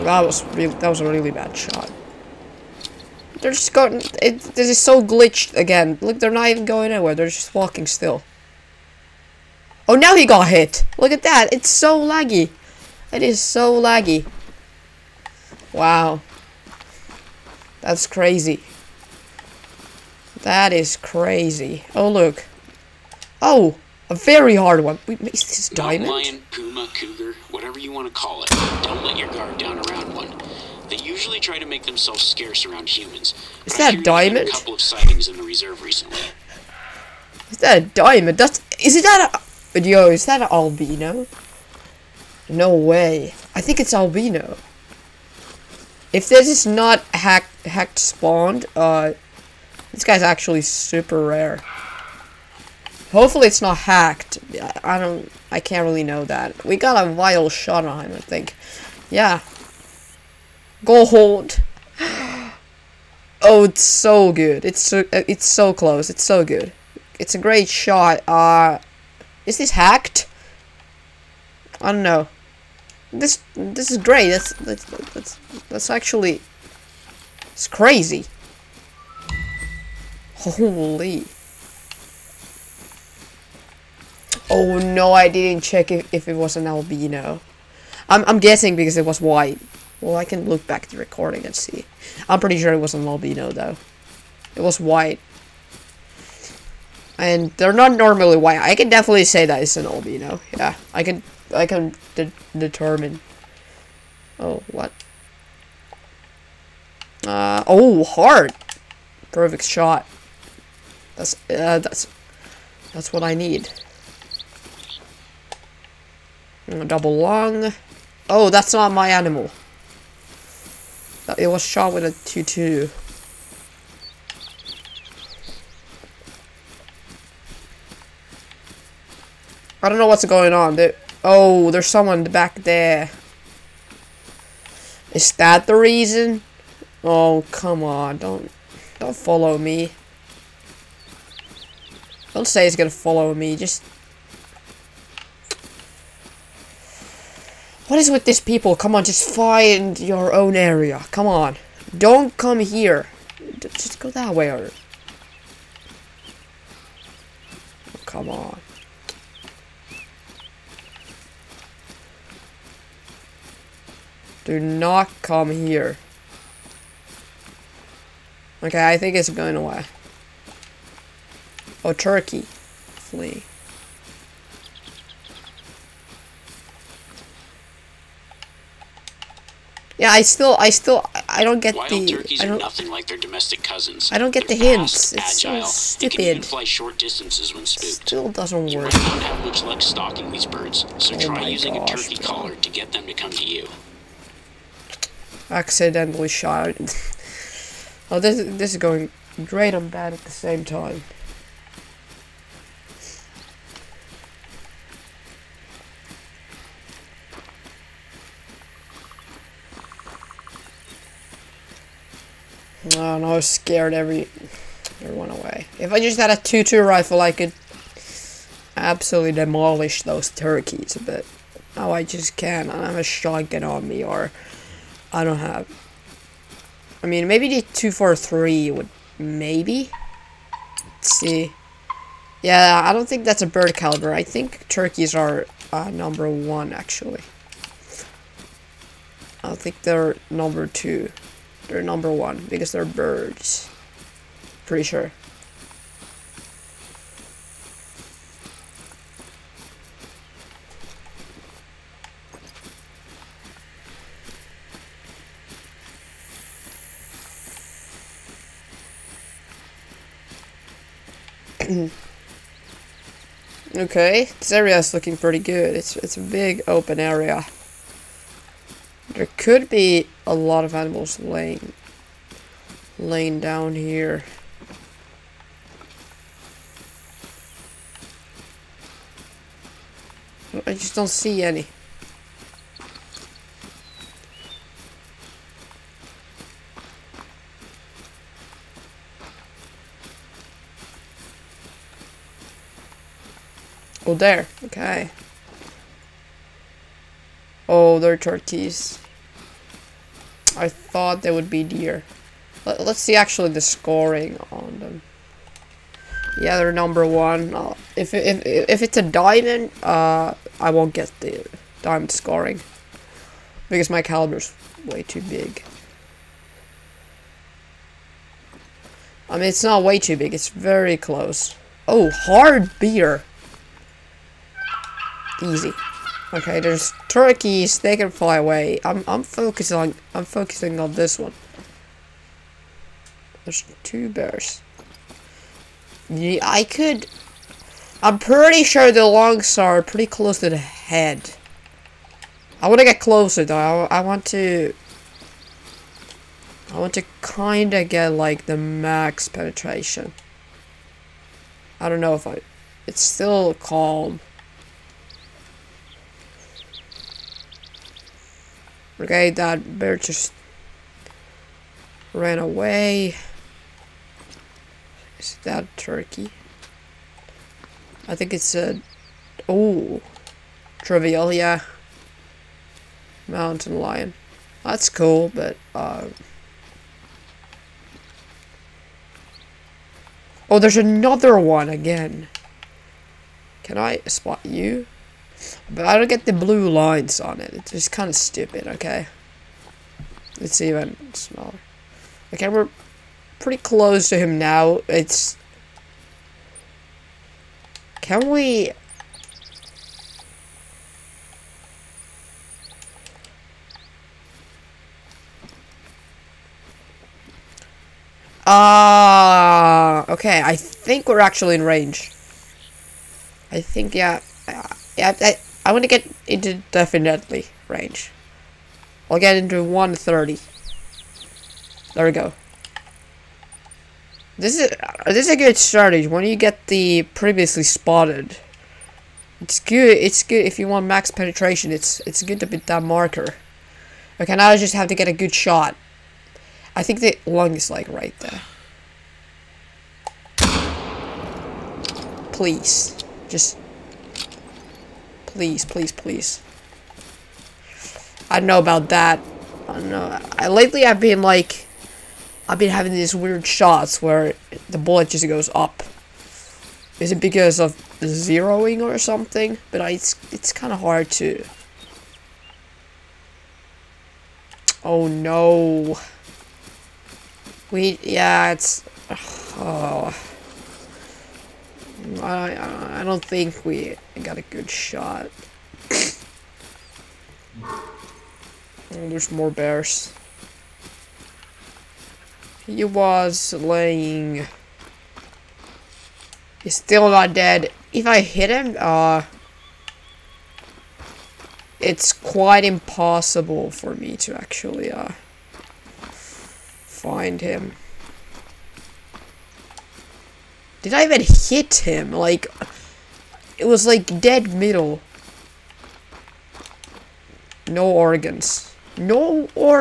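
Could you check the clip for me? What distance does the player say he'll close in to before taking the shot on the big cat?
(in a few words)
130.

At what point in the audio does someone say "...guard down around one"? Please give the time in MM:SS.
00:29.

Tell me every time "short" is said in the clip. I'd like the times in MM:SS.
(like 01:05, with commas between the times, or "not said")
03:06.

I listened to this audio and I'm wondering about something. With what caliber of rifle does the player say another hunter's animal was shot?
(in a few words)
2-2.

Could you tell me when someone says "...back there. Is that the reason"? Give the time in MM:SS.
02:12.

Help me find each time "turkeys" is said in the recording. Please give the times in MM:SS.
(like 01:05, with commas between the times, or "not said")
02:51, 03:02, 03:11, 03:40, 03:54, 04:58, 05:27, 06:05.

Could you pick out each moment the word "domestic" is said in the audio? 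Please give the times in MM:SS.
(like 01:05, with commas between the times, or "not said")
03:03.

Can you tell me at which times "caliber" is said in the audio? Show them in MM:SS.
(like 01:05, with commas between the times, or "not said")
03:53, 05:14.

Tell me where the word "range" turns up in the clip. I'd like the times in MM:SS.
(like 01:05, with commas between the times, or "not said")
06:51, 06:57.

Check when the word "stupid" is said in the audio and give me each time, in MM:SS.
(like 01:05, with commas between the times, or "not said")
03:05, 06:28.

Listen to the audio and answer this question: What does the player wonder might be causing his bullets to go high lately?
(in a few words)
Zeroing.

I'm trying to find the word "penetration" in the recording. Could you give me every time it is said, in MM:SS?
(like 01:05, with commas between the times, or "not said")
05:49, 07:11.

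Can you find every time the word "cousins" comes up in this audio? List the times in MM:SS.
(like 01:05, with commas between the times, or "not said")
03:03.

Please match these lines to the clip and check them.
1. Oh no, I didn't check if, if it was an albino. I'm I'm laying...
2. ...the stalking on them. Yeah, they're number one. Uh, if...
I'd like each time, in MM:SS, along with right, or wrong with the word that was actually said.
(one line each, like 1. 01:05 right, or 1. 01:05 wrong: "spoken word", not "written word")
1. 01:24 wrong: "guessing", not "laying"
2. 05:03 wrong: "scoring", not "stalking".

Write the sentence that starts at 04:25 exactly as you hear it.
It's, it's a big open area.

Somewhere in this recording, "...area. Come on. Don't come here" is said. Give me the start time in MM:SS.
02:30.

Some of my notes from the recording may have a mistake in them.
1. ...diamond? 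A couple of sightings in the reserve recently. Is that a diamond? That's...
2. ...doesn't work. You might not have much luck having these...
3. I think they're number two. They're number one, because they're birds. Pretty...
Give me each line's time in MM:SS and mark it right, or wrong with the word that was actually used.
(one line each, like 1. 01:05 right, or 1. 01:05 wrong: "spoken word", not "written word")
1. 00:34 right
2. 03:08 wrong: "stalking", not "having"
3. 03:59 right.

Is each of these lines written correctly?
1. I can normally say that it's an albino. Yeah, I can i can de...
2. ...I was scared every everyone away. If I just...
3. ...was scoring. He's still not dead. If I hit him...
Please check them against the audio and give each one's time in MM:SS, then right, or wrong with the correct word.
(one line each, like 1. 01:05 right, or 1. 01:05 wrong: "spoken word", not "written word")
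1. 01:38 wrong: "definitely", not "normally"
2. 03:33 right
3. 08:02 wrong: "laying", not "scoring".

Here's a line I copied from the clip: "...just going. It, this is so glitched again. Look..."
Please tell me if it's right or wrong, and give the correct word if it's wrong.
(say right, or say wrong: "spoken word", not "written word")
right.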